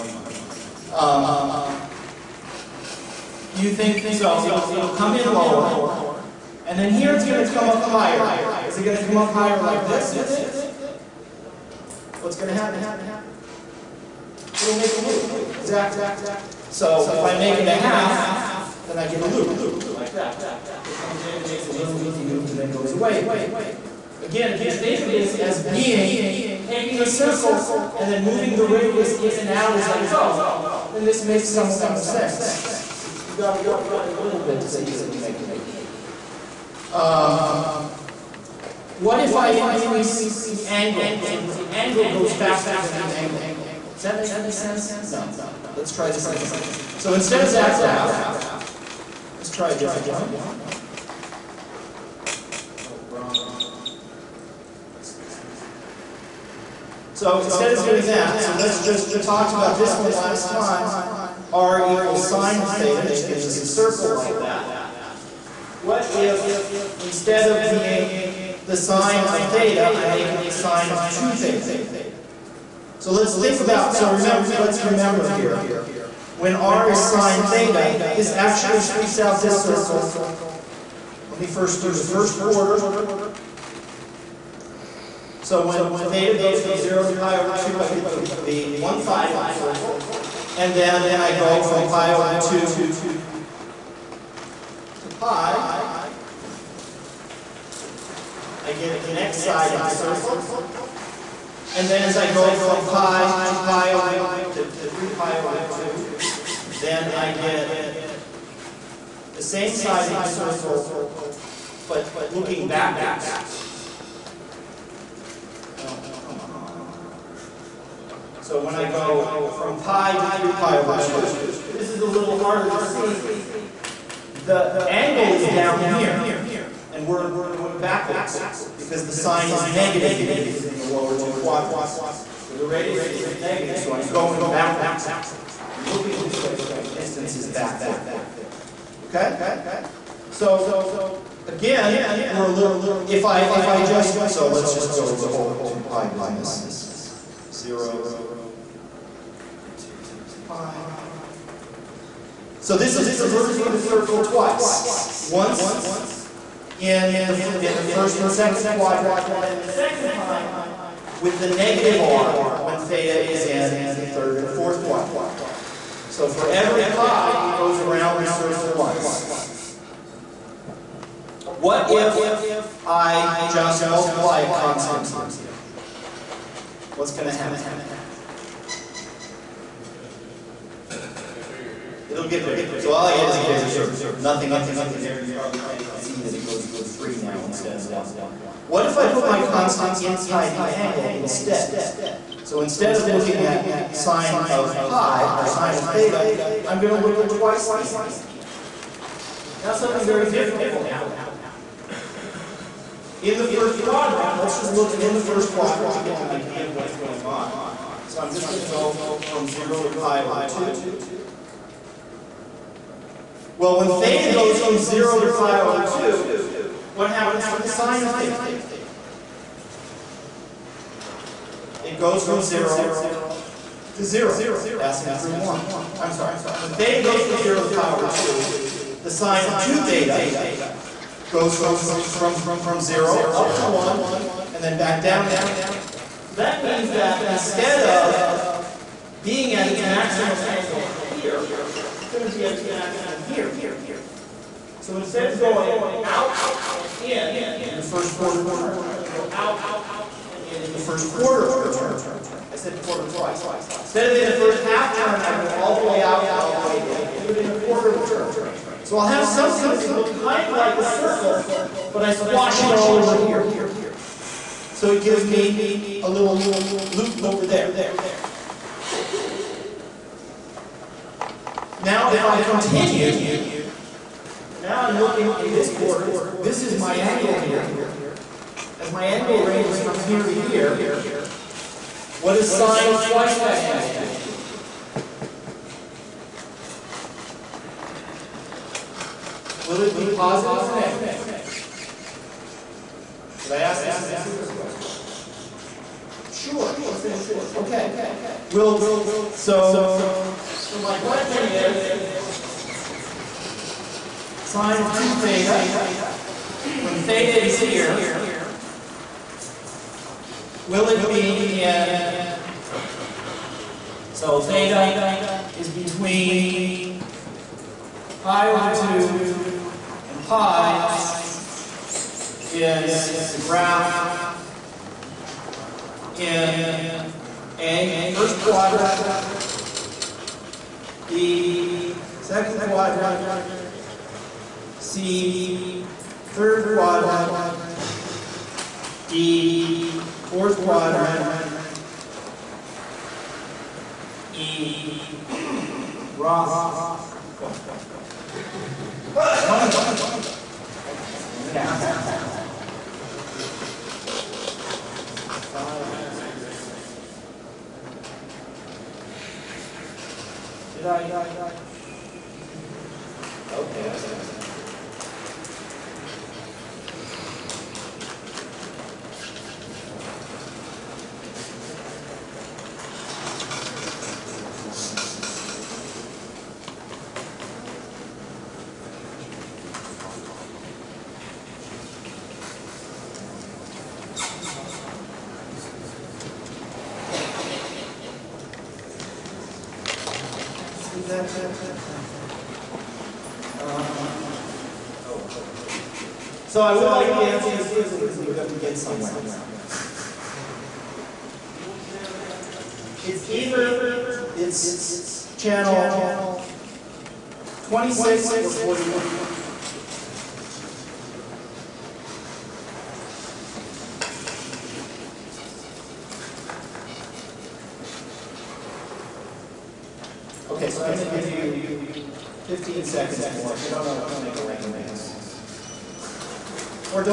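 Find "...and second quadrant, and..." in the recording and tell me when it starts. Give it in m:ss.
2:38.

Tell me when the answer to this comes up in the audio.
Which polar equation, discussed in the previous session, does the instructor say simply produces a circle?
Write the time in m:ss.
1:01.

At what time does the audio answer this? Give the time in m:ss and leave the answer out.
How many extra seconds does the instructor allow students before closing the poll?
7:02.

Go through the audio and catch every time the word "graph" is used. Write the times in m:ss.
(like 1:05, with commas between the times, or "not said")
0:47, 5:23.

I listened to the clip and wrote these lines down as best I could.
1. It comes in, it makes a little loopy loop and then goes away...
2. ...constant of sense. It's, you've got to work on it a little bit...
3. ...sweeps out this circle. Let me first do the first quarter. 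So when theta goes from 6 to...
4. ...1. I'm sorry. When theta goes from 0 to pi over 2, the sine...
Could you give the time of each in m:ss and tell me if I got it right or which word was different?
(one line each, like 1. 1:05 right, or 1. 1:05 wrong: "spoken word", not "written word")
1. 0:20 right
2. 0:31 wrong: "amount", not "constant"
3. 1:18 wrong: "0", not "6"
4. 3:45 right.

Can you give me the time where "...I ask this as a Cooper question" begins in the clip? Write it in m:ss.
4:53.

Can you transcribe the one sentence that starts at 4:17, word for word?
I do it in a quarter of a turn.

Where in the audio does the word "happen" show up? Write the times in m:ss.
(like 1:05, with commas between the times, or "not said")
0:12, 2:57, 3:20, 3:37.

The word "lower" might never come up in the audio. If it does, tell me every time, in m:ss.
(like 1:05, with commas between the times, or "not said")
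0:05, 2:10.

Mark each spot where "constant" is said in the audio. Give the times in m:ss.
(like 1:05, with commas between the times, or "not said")
2:54, 3:09.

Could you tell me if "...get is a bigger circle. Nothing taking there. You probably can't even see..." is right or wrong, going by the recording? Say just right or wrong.
wrong.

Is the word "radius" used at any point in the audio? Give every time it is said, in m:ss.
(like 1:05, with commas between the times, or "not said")
0:28, 2:12.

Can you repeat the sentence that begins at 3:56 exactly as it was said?
So that means that instead of being at its maximum angle here, proximity of its maximum here.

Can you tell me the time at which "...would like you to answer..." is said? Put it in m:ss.
6:36.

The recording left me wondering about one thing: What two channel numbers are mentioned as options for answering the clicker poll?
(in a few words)
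26 or 41.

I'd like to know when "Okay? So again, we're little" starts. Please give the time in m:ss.
2:19.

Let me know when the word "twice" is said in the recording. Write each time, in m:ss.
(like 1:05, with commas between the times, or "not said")
2:34, 3:17, 4:13, 4:43.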